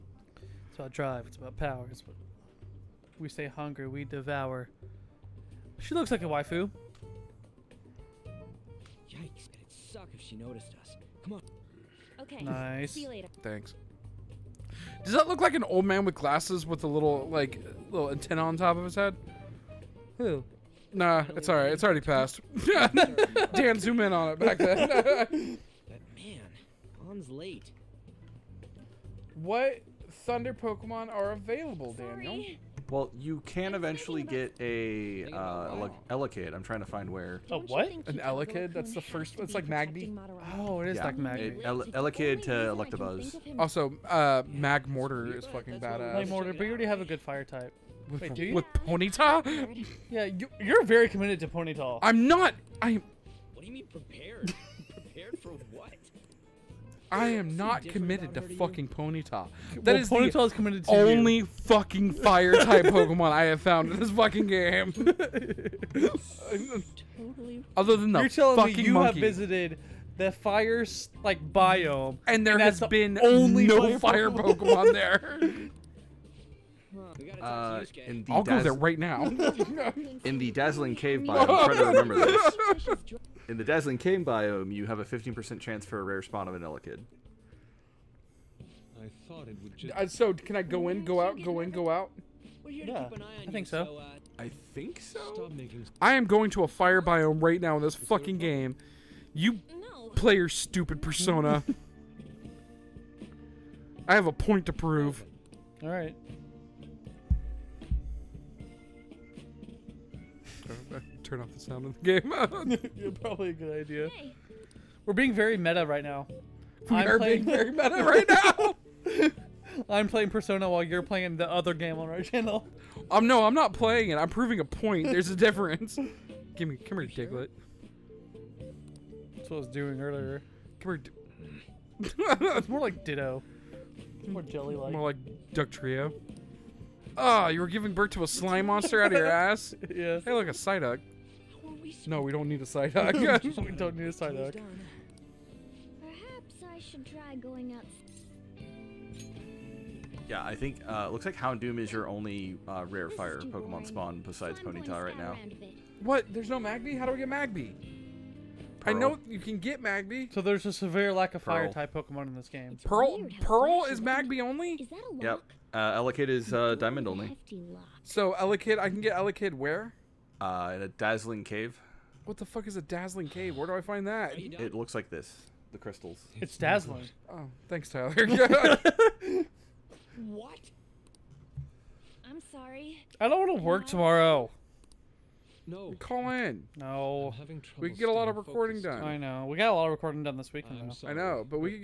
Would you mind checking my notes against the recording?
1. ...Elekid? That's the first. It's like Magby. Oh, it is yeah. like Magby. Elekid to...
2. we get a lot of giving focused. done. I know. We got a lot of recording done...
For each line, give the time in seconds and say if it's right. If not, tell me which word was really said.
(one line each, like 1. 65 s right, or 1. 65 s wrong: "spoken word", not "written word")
1. 38 s right
2. 187 s wrong: "recording", not "giving".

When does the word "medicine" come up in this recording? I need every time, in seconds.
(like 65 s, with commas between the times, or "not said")
not said.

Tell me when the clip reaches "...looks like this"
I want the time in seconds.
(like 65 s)
174 s.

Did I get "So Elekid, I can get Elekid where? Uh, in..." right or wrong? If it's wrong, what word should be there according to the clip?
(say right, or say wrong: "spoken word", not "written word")
right.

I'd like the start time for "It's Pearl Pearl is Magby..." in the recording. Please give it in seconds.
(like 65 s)
162 s.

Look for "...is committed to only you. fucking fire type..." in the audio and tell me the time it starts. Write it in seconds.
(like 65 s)
60 s.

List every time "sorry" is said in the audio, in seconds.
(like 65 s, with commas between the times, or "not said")
31 s, 182 s.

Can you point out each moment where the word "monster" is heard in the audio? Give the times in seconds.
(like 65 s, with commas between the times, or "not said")
138 s.